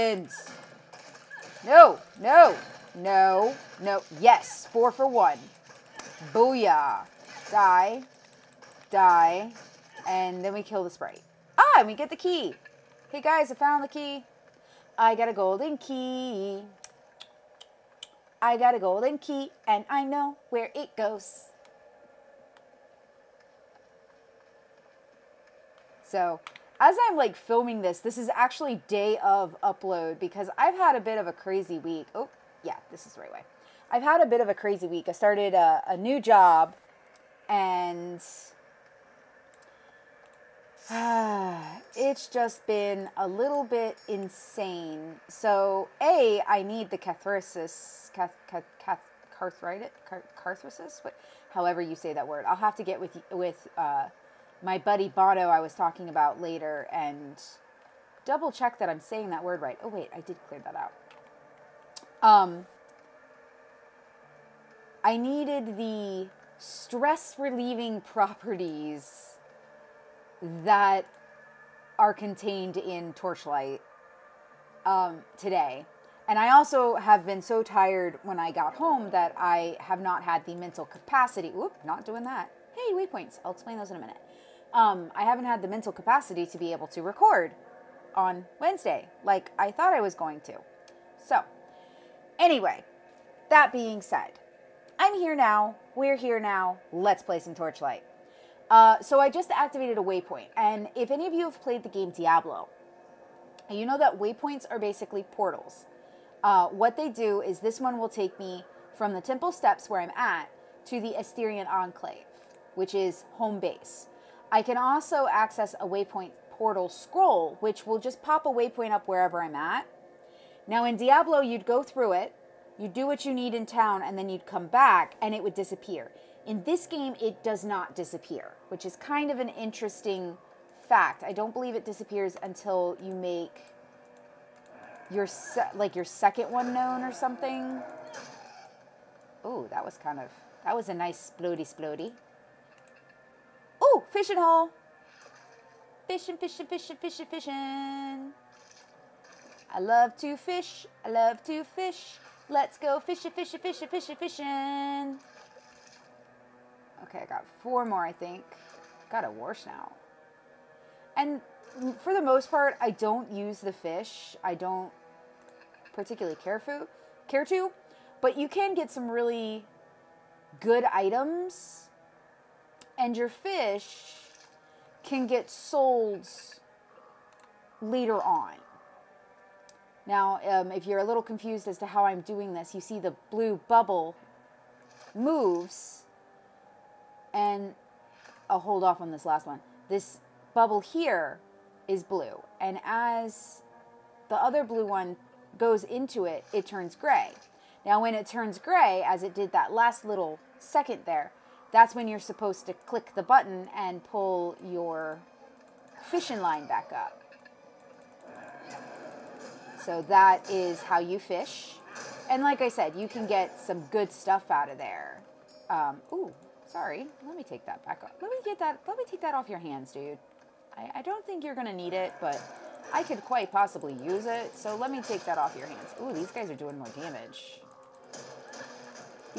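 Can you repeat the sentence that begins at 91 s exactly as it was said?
So, anyway, that being said, I'm here now.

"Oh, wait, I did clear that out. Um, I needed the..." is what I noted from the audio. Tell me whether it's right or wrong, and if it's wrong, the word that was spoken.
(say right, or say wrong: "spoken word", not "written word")
right.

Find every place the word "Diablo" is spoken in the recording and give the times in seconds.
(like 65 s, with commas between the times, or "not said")
102 s, 120 s.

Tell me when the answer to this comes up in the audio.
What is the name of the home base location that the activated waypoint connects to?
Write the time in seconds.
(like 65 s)
111 s.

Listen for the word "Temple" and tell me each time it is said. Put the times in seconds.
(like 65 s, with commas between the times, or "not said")
109 s.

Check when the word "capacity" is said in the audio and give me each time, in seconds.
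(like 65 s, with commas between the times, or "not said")
80 s, 85 s.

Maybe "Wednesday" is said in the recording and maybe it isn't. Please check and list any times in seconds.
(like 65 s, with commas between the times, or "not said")
88 s.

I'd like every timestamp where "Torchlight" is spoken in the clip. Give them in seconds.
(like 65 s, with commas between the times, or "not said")
73 s, 97 s.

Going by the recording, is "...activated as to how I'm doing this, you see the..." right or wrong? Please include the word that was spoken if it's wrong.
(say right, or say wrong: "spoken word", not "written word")
wrong: "confused", not "activated".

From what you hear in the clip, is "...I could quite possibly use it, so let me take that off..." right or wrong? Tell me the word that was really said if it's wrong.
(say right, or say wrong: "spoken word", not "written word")
right.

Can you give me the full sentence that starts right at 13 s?
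Hey guys, I found the key.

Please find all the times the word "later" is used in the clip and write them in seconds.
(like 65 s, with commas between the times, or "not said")
56 s, 177 s.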